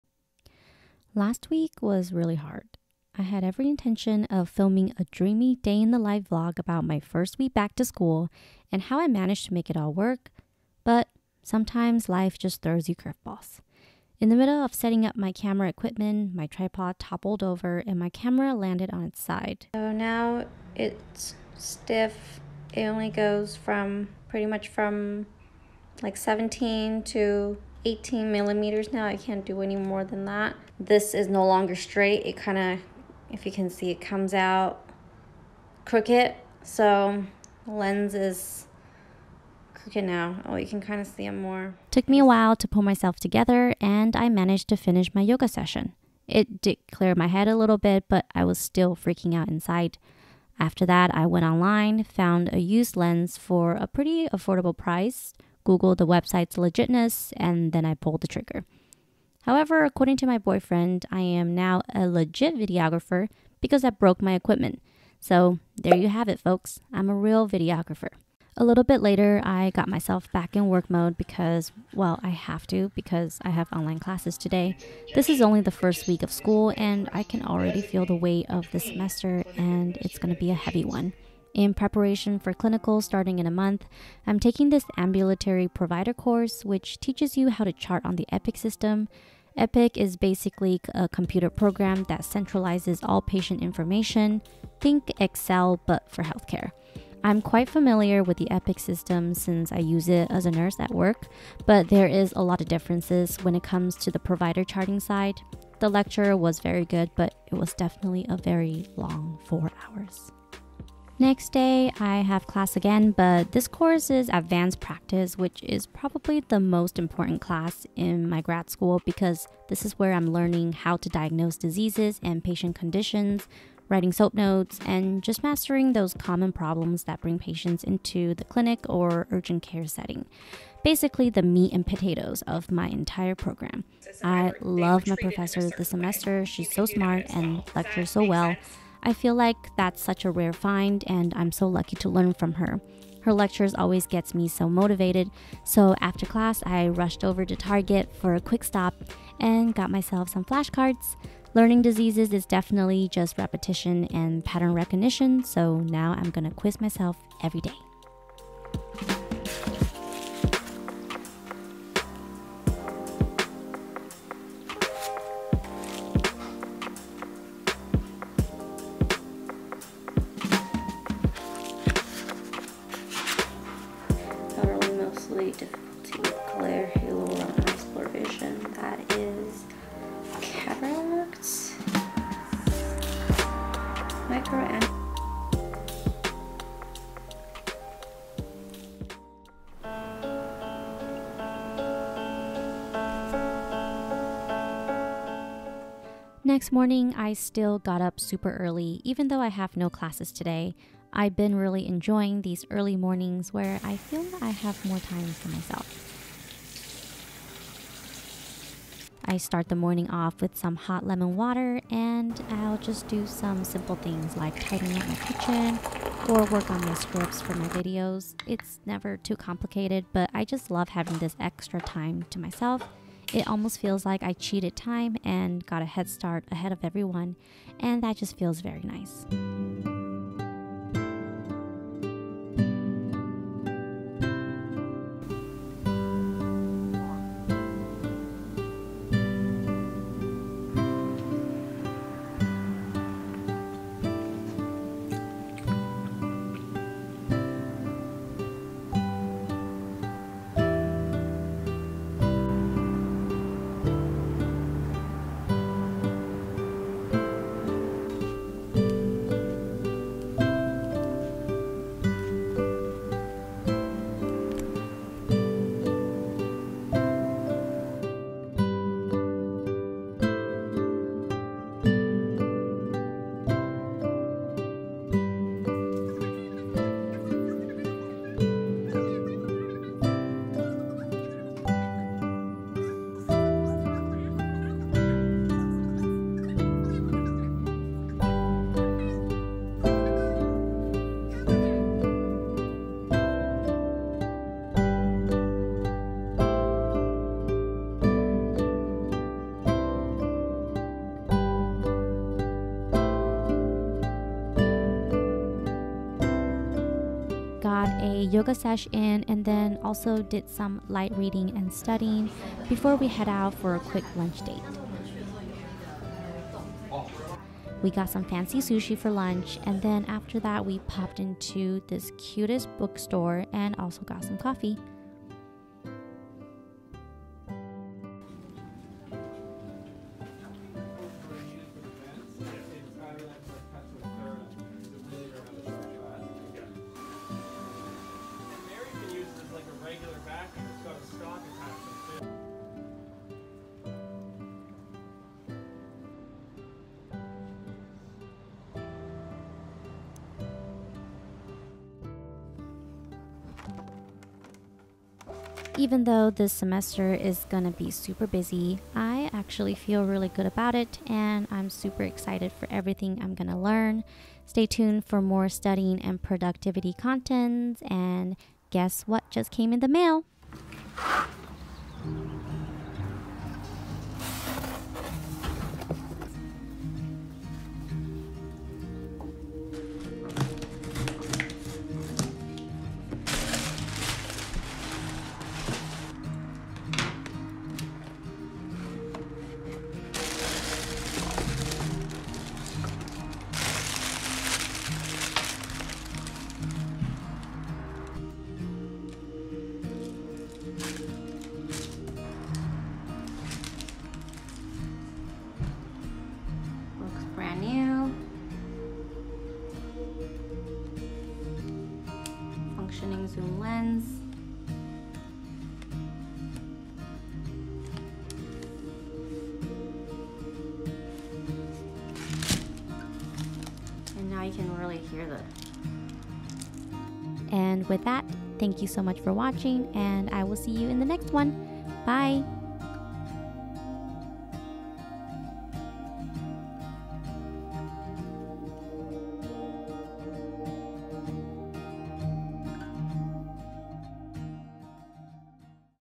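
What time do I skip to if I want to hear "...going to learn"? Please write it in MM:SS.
06:03.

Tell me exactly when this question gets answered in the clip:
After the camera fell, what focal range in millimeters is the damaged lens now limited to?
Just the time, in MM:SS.
00:26.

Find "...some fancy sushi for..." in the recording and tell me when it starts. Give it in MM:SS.
05:18.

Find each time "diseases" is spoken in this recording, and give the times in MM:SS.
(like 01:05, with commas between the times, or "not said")
02:01, 02:31.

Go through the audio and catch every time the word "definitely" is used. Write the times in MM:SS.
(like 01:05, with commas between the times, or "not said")
01:47, 02:32.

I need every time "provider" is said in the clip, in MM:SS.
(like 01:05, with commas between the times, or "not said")
01:25, 01:44.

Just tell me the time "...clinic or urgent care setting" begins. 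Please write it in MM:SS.
02:08.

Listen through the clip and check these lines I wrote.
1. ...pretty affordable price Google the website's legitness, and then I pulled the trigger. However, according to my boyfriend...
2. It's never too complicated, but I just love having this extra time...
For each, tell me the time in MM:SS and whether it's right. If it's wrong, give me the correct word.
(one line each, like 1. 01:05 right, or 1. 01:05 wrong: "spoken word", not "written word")
1. 00:53 right
2. 03:38 right.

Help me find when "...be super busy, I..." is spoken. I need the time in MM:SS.
05:57.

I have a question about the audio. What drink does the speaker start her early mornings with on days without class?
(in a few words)
Hot lemon water.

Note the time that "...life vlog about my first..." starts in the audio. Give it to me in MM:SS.
00:05.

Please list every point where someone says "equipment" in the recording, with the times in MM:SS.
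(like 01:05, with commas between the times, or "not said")
00:15, 01:04.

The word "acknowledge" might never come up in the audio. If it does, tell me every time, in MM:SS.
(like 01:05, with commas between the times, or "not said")
not said.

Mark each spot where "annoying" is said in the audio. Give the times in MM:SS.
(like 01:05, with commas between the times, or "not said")
not said.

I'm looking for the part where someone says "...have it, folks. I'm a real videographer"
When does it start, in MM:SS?
01:06.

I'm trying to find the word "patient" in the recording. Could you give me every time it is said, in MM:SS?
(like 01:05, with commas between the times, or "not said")
01:33, 02:02, 02:07.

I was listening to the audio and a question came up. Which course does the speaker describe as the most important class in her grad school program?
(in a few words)
Advanced practice.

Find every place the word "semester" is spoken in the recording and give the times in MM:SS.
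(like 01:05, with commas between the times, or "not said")
01:18, 02:15, 05:56.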